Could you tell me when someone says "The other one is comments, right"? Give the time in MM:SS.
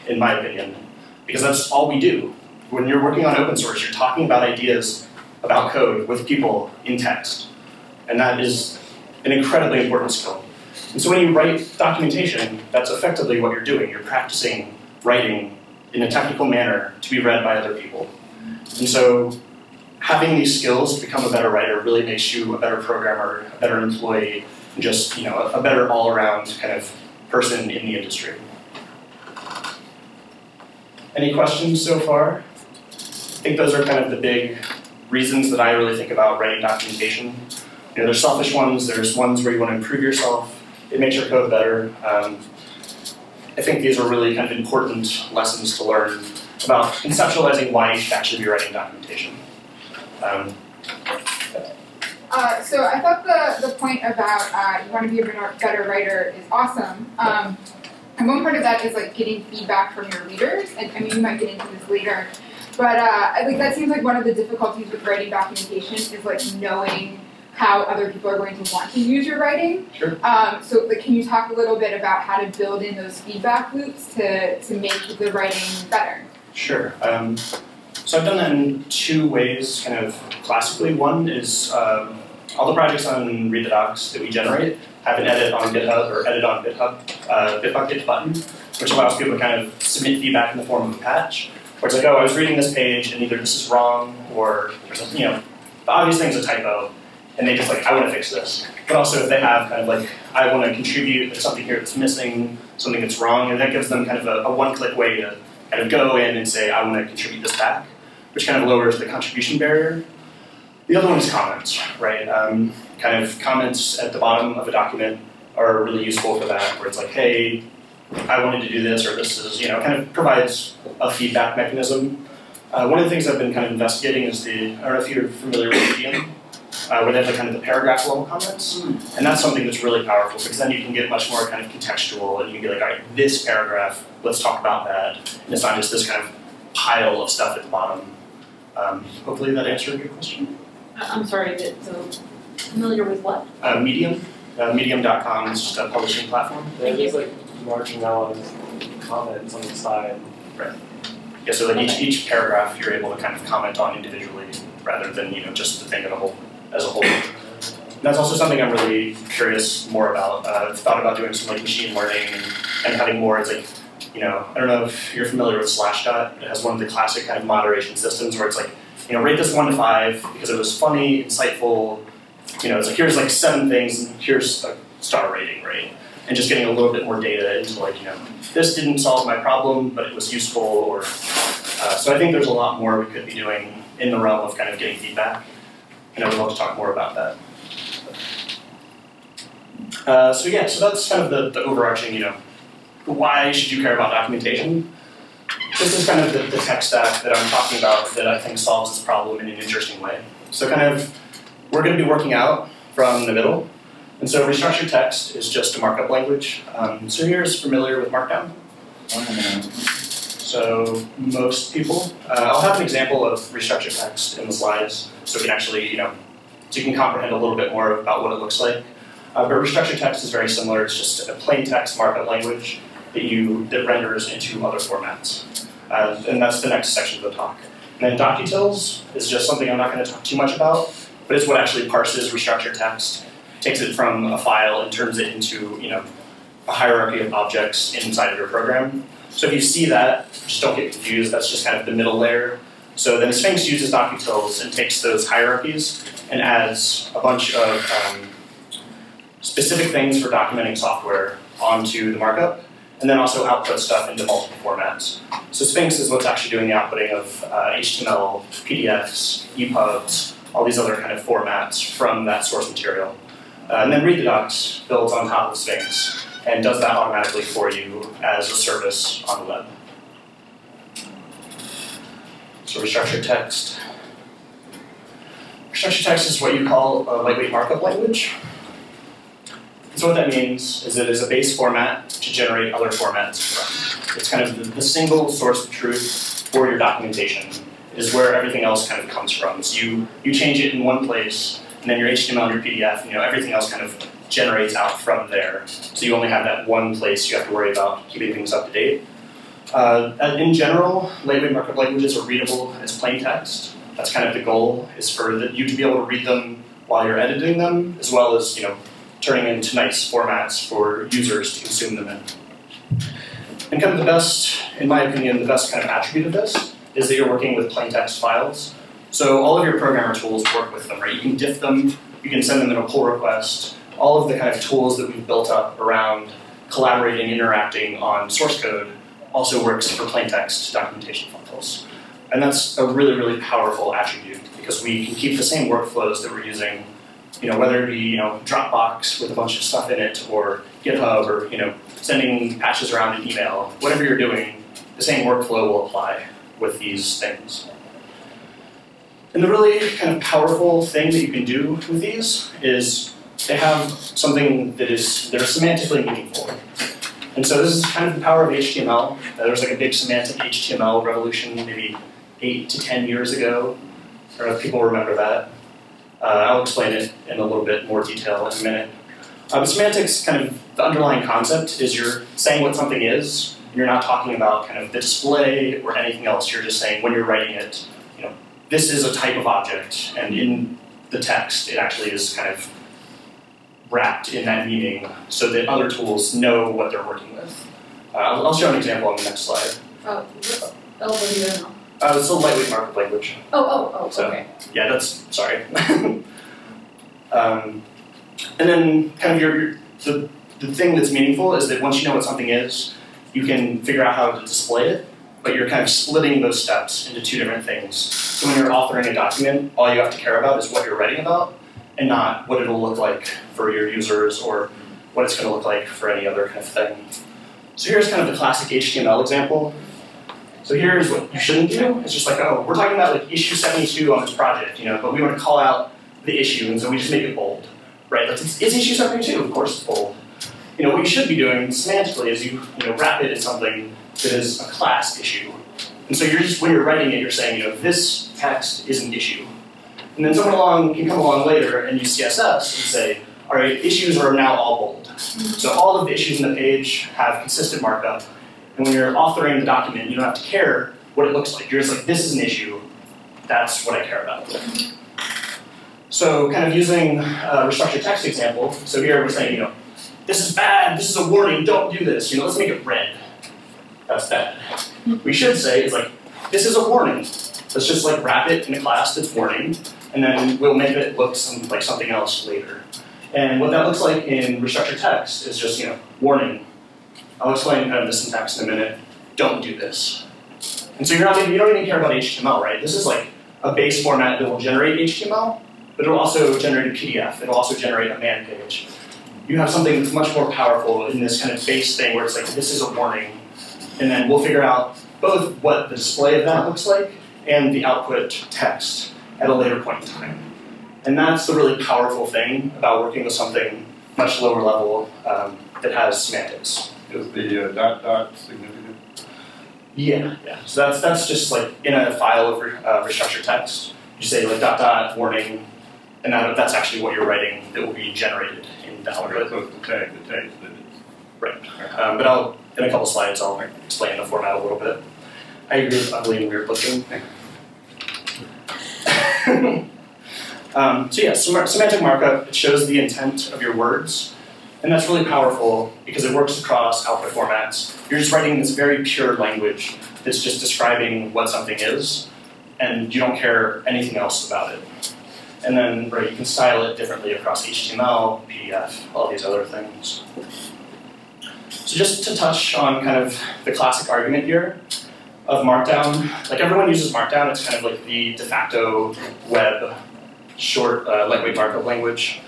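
01:50.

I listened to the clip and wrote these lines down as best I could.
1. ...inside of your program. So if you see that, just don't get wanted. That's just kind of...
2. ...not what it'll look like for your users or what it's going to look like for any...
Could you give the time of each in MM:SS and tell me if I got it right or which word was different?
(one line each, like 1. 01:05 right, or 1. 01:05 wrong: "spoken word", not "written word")
1. 03:57 wrong: "confused", not "wanted"
2. 06:52 right.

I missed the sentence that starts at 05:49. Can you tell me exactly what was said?
And the really kind of powerful thing that you can do with these is they have something that is, they're semantically meaningful.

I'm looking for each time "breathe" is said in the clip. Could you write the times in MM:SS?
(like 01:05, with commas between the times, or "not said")
not said.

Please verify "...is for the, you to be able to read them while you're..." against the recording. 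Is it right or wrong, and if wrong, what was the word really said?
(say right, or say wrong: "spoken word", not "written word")
right.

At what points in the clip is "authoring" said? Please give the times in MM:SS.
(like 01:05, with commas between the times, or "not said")
06:48, 07:29.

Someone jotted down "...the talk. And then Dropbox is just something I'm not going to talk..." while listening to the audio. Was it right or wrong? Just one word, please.
wrong.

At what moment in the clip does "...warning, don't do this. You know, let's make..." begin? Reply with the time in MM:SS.
07:41.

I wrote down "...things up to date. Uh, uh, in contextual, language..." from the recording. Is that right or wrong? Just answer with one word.
wrong.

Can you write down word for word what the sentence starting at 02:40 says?
Uh, I've thought about doing some like machine learning and, and having more.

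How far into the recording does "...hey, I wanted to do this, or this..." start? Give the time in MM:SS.
01:57.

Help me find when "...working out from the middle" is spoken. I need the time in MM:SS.
03:22.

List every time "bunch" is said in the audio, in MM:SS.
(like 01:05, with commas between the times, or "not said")
04:07, 05:39.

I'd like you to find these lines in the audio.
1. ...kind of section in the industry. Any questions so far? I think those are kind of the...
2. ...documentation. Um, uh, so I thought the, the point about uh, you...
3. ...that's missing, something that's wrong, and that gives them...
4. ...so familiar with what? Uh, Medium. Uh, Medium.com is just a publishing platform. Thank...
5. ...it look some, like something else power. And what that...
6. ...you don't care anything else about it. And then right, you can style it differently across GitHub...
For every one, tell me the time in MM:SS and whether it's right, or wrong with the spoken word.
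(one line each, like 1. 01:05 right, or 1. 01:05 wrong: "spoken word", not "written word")
1. 00:26 wrong: "person", not "section"
2. 00:48 right
3. 01:41 right
4. 02:21 right
5. 07:50 wrong: "later", not "power"
6. 09:03 wrong: "HTML", not "GitHub".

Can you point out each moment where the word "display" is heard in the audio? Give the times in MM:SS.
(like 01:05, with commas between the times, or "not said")
06:14, 06:44, 08:15.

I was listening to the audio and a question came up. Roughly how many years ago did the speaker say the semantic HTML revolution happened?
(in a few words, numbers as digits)
8 to 10 years.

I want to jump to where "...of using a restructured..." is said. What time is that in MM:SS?
07:36.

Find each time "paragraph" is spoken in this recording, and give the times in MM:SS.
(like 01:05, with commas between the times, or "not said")
02:07, 02:13, 02:32.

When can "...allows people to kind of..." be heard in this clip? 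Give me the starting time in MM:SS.
01:28.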